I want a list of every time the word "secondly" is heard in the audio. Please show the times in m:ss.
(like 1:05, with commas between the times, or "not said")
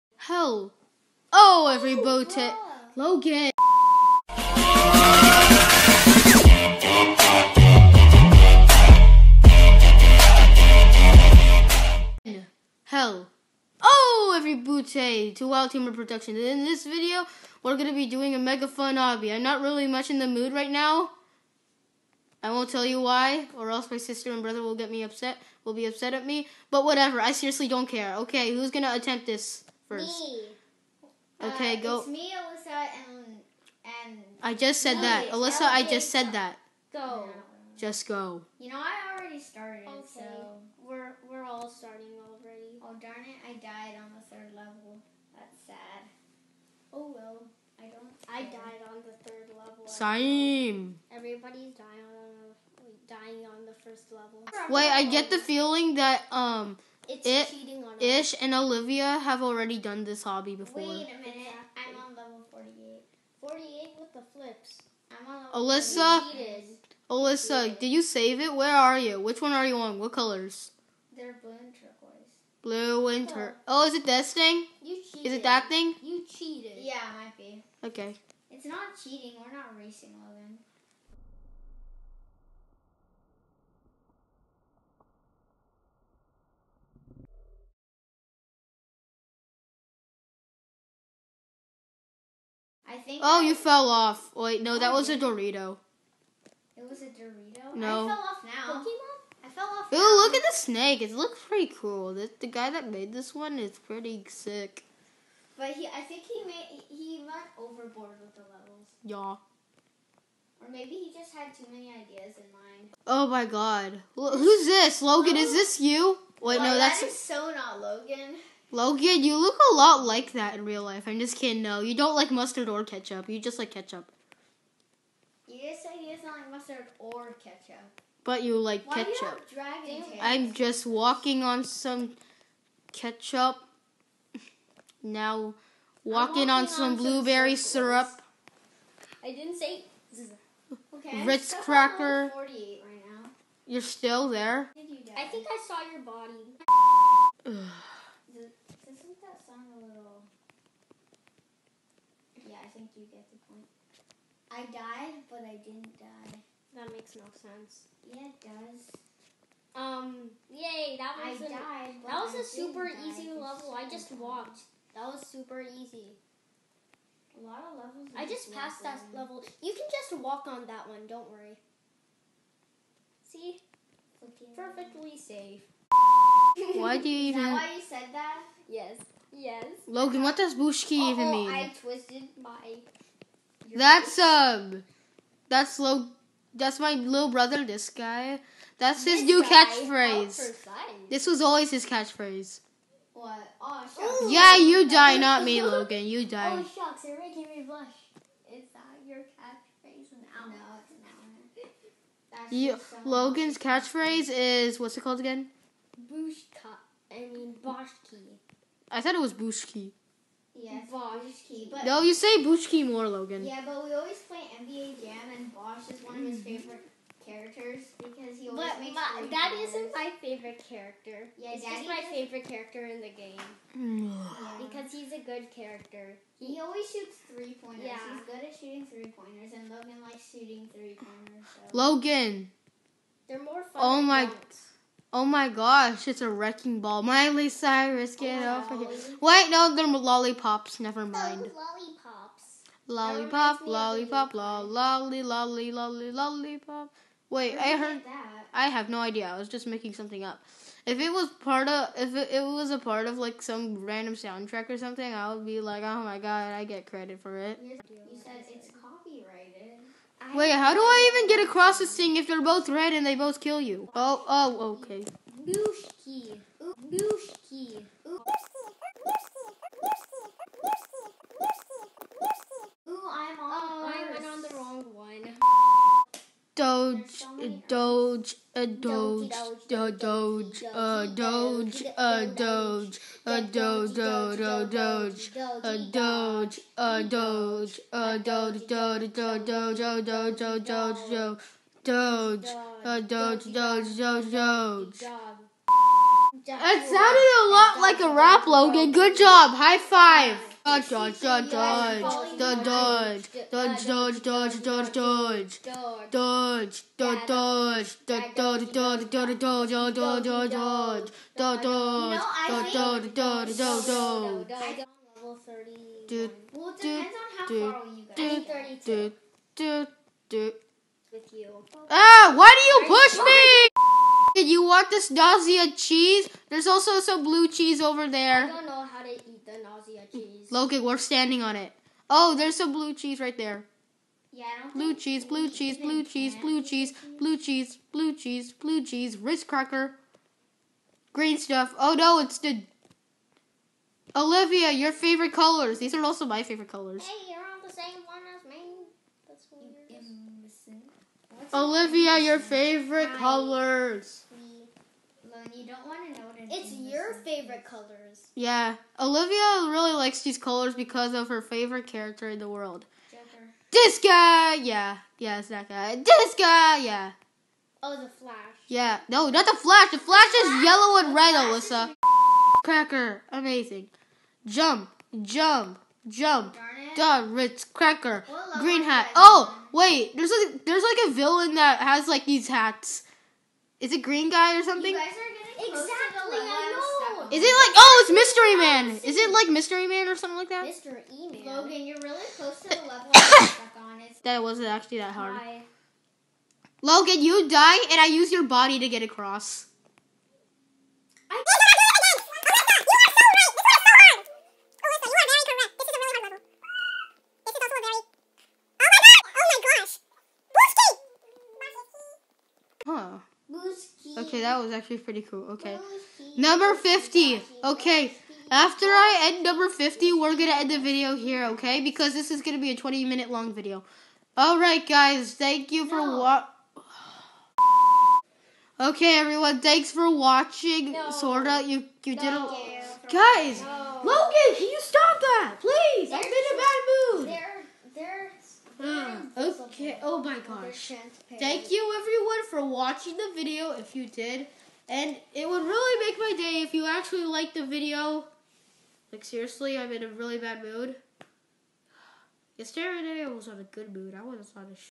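not said.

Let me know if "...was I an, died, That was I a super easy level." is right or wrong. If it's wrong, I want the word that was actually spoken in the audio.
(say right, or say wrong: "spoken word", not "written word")
right.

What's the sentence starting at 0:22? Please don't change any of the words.
I won't tell you why, or else my sister and brother will get me upset, will be upset at me.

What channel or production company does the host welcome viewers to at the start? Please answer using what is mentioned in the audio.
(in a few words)
Wild Humor Productions.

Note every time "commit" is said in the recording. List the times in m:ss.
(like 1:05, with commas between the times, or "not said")
not said.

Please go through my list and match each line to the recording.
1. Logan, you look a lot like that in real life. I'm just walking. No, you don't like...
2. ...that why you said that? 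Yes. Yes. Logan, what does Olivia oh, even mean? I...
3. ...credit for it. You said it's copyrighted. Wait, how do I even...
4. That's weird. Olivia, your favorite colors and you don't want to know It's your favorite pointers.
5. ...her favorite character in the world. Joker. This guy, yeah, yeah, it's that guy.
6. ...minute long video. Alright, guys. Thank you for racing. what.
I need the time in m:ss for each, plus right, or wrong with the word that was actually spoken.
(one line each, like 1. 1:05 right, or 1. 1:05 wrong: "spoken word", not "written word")
1. 1:58 wrong: "kidding", not "walking"
2. 2:57 wrong: "Bushki", not "Olivia"
3. 4:16 right
4. 5:49 wrong: "colors", not "pointers"
5. 6:01 right
6. 7:03 wrong: "watching", not "racing".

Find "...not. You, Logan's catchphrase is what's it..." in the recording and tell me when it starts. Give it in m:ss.
3:22.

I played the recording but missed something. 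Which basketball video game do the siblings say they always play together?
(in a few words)
NBA Jam.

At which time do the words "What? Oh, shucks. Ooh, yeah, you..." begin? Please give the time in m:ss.
3:13.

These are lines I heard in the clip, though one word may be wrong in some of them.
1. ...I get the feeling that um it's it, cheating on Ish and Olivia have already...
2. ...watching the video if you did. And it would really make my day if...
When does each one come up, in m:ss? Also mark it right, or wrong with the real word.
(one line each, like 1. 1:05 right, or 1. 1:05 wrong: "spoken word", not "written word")
1. 0:54 right
2. 7:22 right.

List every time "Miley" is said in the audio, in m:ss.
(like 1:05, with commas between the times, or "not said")
3:57.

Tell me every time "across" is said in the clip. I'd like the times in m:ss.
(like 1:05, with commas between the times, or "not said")
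4:21.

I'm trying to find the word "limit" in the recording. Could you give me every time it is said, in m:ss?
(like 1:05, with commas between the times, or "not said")
not said.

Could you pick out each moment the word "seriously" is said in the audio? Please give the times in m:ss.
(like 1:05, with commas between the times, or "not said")
0:27, 7:29.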